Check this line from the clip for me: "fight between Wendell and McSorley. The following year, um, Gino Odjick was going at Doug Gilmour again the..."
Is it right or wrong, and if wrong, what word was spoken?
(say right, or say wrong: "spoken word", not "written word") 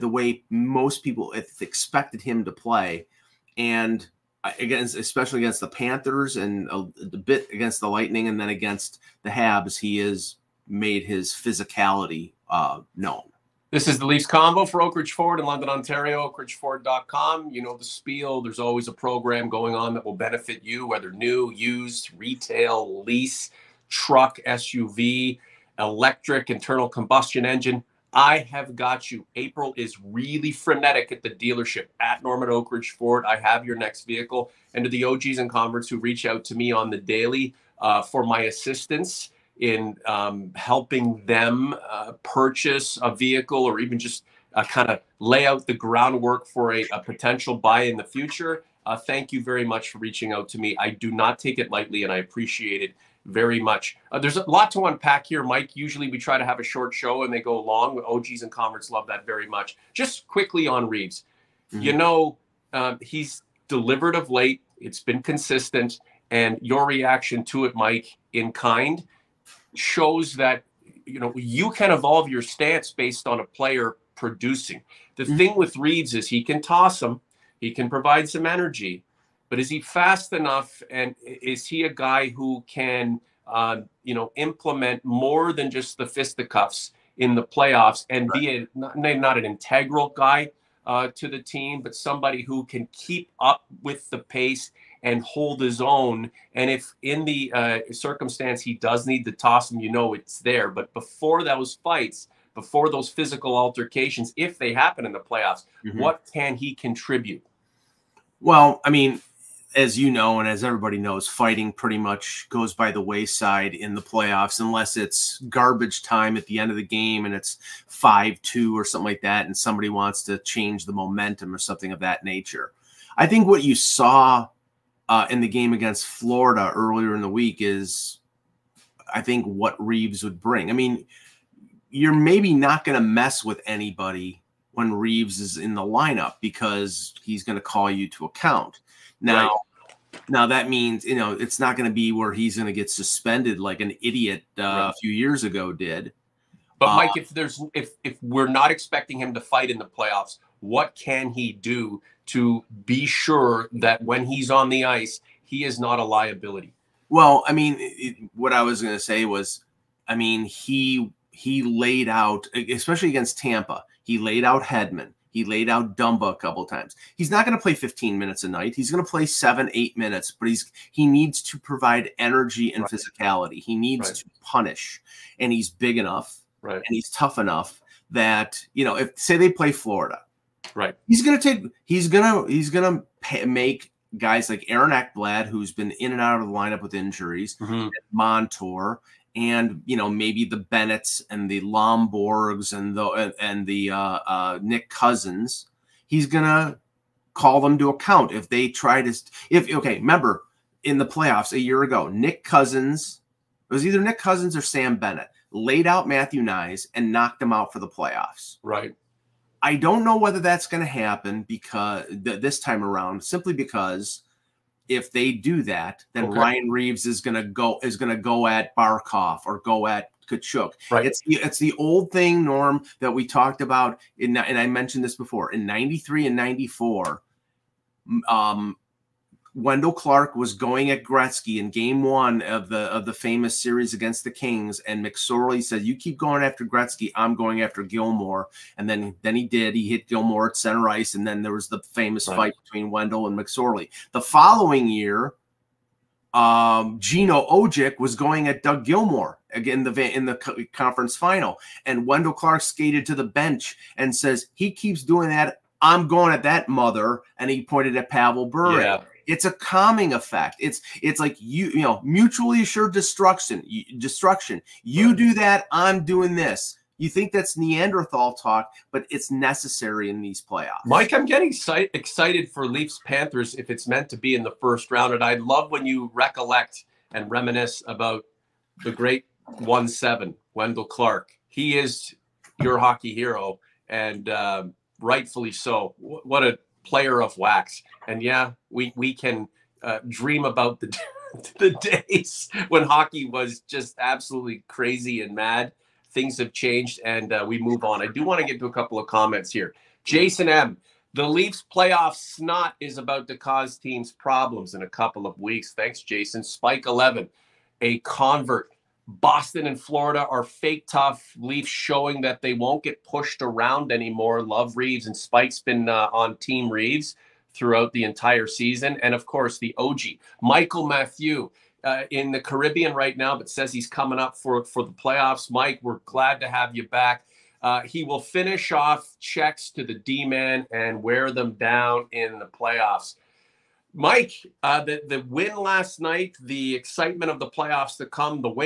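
right.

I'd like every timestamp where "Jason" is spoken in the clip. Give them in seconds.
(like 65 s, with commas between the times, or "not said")
300 s, 306 s.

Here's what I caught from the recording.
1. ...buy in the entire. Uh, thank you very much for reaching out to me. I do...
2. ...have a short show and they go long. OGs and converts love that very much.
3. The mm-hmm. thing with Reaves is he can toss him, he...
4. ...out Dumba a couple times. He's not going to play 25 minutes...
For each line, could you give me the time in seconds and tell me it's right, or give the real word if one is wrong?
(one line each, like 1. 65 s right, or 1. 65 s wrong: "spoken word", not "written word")
1. 47 s wrong: "future", not "entire"
2. 56 s right
3. 75 s right
4. 165 s wrong: "15", not "25".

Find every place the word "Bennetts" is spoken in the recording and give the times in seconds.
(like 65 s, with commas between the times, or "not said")
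190 s, 204 s.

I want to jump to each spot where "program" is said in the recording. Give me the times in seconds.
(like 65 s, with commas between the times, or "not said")
18 s.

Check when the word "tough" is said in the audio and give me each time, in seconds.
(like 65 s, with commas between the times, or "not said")
177 s, 310 s.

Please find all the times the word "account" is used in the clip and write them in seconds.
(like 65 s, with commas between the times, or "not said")
138 s, 197 s.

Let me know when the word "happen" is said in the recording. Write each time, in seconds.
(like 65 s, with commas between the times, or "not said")
104 s, 210 s.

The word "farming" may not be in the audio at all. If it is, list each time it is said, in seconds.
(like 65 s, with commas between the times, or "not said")
not said.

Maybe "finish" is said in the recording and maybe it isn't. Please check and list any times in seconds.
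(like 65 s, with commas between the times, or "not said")
328 s.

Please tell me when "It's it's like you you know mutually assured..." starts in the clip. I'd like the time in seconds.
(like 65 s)
260 s.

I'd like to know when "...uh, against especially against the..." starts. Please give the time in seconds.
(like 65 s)
4 s.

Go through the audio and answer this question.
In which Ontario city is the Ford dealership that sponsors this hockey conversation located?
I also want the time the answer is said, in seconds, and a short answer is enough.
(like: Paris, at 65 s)
London, at 15 s.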